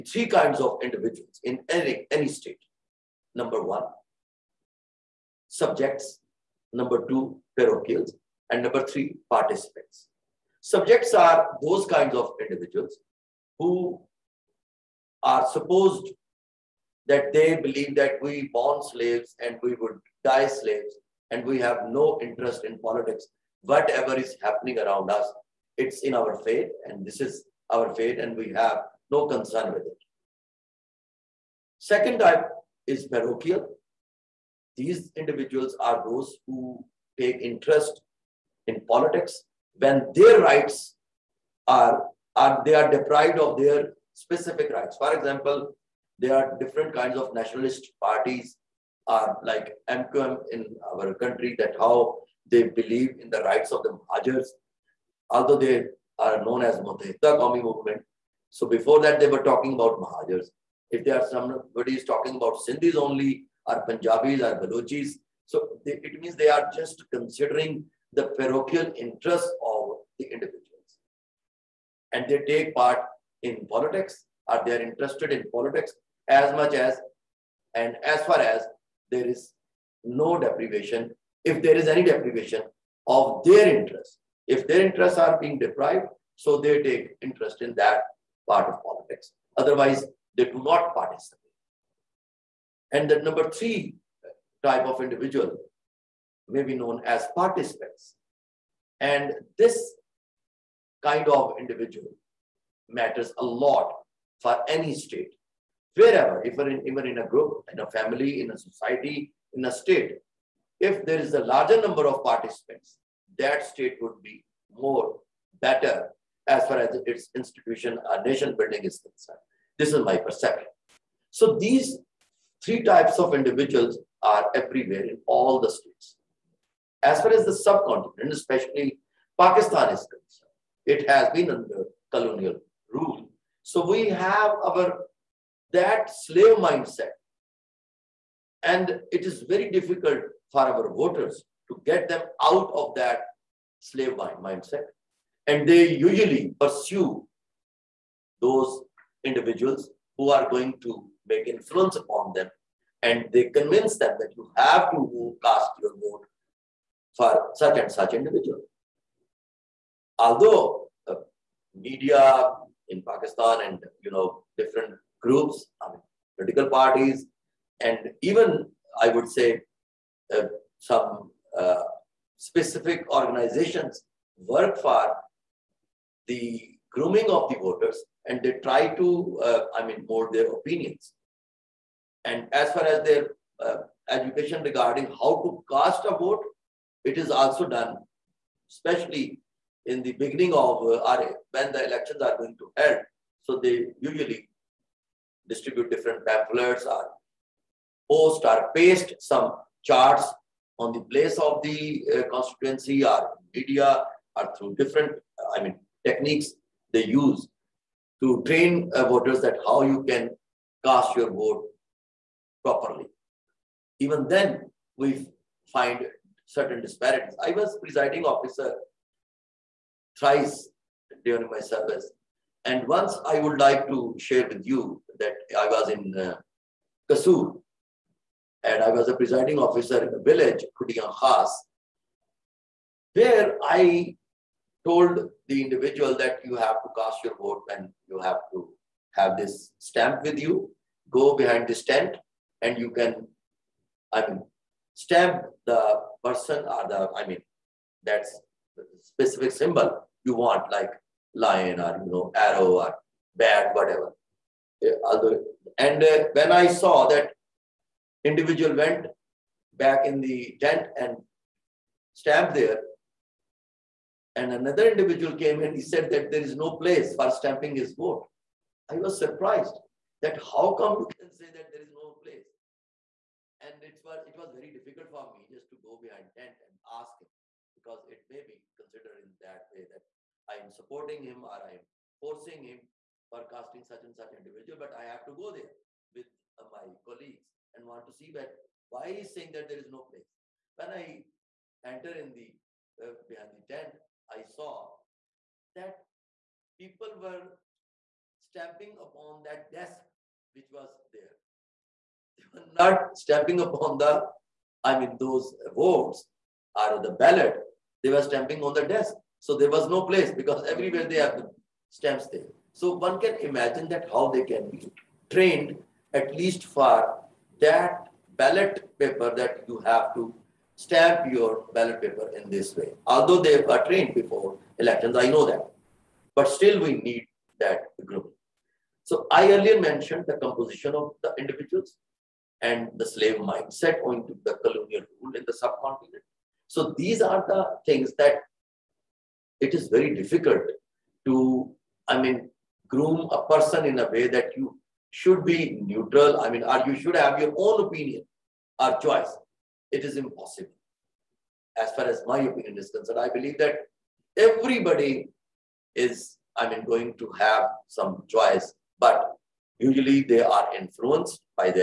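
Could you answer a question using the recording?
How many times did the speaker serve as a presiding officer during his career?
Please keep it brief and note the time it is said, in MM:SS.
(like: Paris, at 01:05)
3, at 03:40.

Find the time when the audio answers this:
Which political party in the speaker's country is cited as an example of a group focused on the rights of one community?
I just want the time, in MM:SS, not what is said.
00:49.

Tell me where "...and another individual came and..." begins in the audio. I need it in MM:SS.
04:24.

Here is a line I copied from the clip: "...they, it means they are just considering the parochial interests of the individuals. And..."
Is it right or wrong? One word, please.
right.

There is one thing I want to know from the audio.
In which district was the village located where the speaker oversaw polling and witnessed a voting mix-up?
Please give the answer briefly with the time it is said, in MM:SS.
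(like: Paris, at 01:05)
Kasur, at 03:47.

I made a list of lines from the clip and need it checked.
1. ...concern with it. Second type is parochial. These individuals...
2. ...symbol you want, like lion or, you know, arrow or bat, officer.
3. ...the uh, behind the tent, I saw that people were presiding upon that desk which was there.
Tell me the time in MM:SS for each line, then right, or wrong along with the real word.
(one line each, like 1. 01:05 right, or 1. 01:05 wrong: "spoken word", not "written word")
1. 00:29 right
2. 04:09 wrong: "whatever", not "officer"
3. 04:52 wrong: "stamping", not "presiding".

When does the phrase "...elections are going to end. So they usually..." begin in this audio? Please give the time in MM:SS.
03:11.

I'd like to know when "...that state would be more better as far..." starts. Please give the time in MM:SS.
01:53.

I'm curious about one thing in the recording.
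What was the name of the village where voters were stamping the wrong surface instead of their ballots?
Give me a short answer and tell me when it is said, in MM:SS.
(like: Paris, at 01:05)
Kudiyan Khas, at 03:50.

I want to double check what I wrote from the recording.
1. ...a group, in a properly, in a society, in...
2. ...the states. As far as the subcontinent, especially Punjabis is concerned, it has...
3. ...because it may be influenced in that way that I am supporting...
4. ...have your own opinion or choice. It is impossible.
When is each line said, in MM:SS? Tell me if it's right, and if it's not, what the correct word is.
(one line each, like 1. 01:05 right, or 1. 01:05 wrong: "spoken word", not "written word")
1. 01:47 wrong: "family", not "properly"
2. 02:05 wrong: "Pakistan", not "Punjabis"
3. 04:37 wrong: "considered", not "influenced"
4. 05:47 right.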